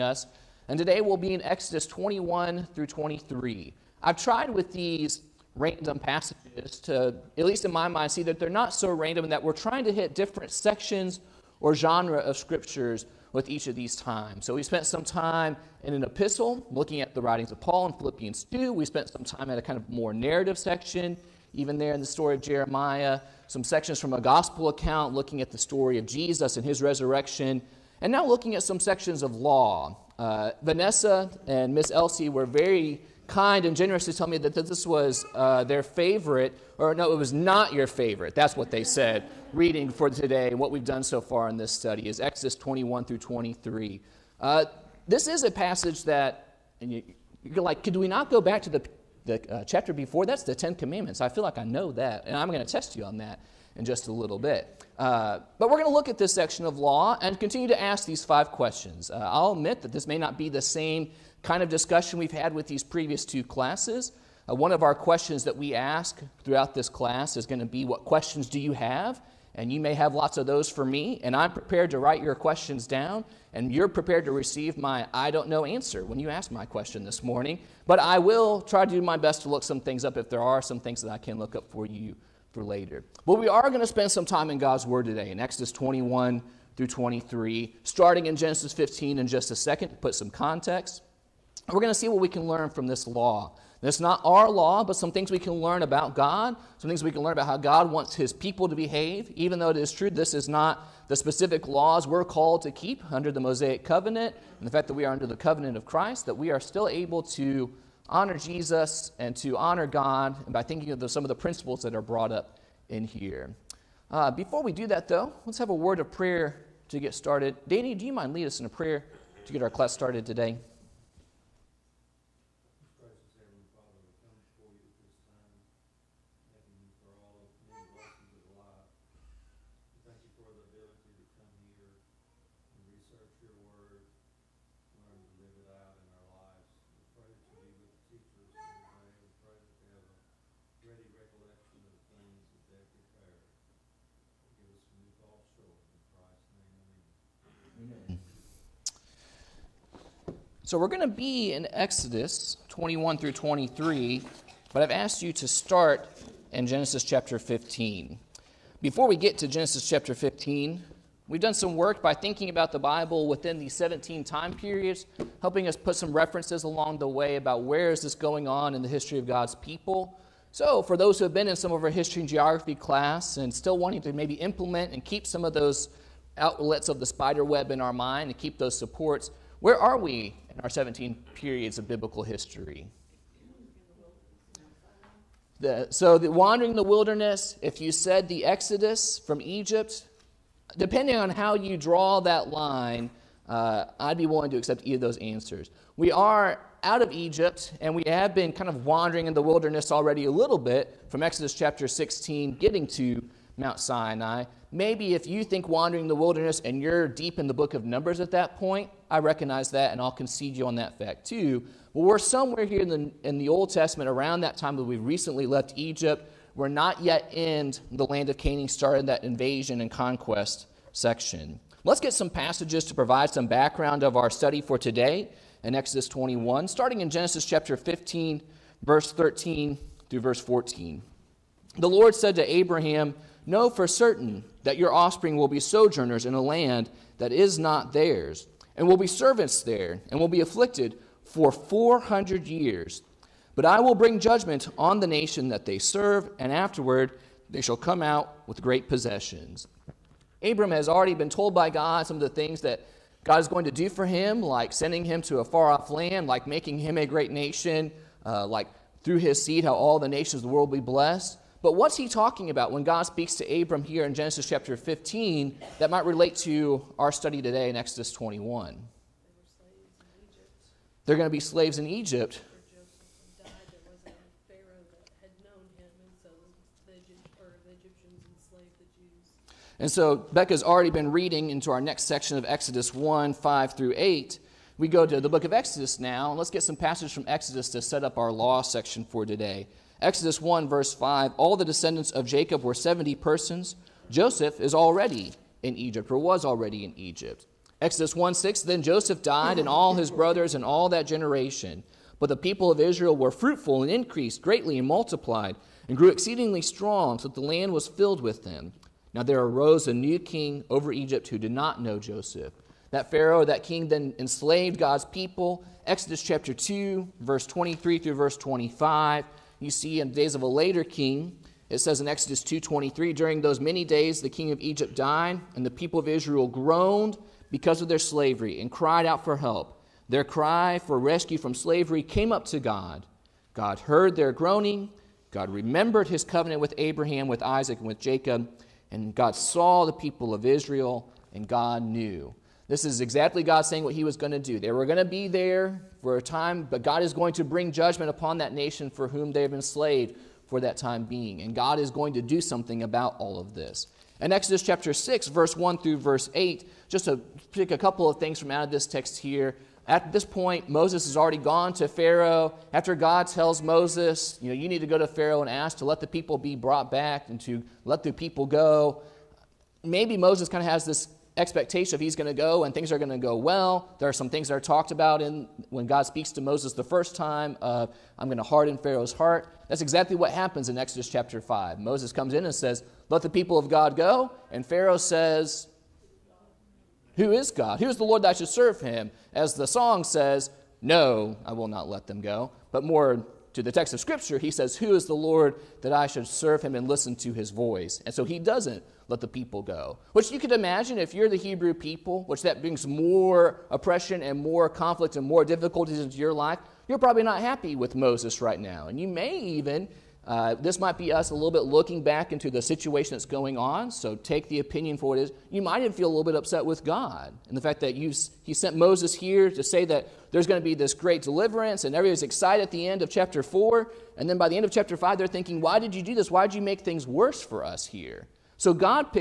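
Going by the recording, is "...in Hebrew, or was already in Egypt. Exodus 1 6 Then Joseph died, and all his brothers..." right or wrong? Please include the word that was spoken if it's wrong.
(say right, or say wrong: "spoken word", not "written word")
wrong: "Egypt", not "Hebrew".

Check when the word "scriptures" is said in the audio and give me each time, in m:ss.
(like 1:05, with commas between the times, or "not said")
0:12, 6:33.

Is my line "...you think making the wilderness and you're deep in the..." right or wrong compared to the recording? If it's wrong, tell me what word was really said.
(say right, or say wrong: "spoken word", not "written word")
wrong: "wandering", not "making".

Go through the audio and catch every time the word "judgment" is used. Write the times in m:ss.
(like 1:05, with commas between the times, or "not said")
4:04, 5:47.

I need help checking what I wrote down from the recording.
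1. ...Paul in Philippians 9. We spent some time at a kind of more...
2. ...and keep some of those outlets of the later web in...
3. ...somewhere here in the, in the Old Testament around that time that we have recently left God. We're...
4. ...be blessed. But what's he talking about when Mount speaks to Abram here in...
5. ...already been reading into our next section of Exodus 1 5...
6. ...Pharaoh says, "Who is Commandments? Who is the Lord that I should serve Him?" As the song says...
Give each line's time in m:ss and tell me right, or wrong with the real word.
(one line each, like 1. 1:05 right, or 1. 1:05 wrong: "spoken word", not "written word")
1. 0:17 wrong: "2", not "9"
2. 2:54 wrong: "spider", not "later"
3. 3:32 wrong: "Egypt", not "God"
4. 4:20 wrong: "God", not "Mount"
5. 4:40 right
6. 6:24 wrong: "God", not "Commandments".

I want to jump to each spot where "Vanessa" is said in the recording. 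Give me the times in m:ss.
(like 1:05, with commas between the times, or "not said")
0:30.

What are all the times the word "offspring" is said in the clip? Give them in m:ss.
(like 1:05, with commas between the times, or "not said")
3:54.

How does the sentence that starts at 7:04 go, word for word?
And then by the end of chapter 5, they're thinking, why did you do this?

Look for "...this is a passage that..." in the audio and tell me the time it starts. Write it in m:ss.
0:45.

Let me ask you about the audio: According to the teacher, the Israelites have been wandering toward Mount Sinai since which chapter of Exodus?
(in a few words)
Exodus 16.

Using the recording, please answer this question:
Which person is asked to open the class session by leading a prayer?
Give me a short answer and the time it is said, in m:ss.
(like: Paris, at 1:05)
Danny, at 1:57.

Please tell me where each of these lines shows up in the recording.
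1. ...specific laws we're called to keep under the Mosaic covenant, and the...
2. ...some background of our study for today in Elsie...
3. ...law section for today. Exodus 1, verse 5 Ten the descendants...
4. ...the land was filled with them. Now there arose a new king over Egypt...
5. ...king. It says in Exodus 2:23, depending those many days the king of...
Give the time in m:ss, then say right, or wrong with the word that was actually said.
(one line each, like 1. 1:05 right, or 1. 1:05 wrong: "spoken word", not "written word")
1. 1:41 right
2. 3:43 wrong: "Exodus", not "Elsie"
3. 4:48 wrong: "All", not "Ten"
4. 5:07 right
5. 5:20 wrong: "during", not "depending".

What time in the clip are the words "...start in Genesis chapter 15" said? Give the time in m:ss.
2:35.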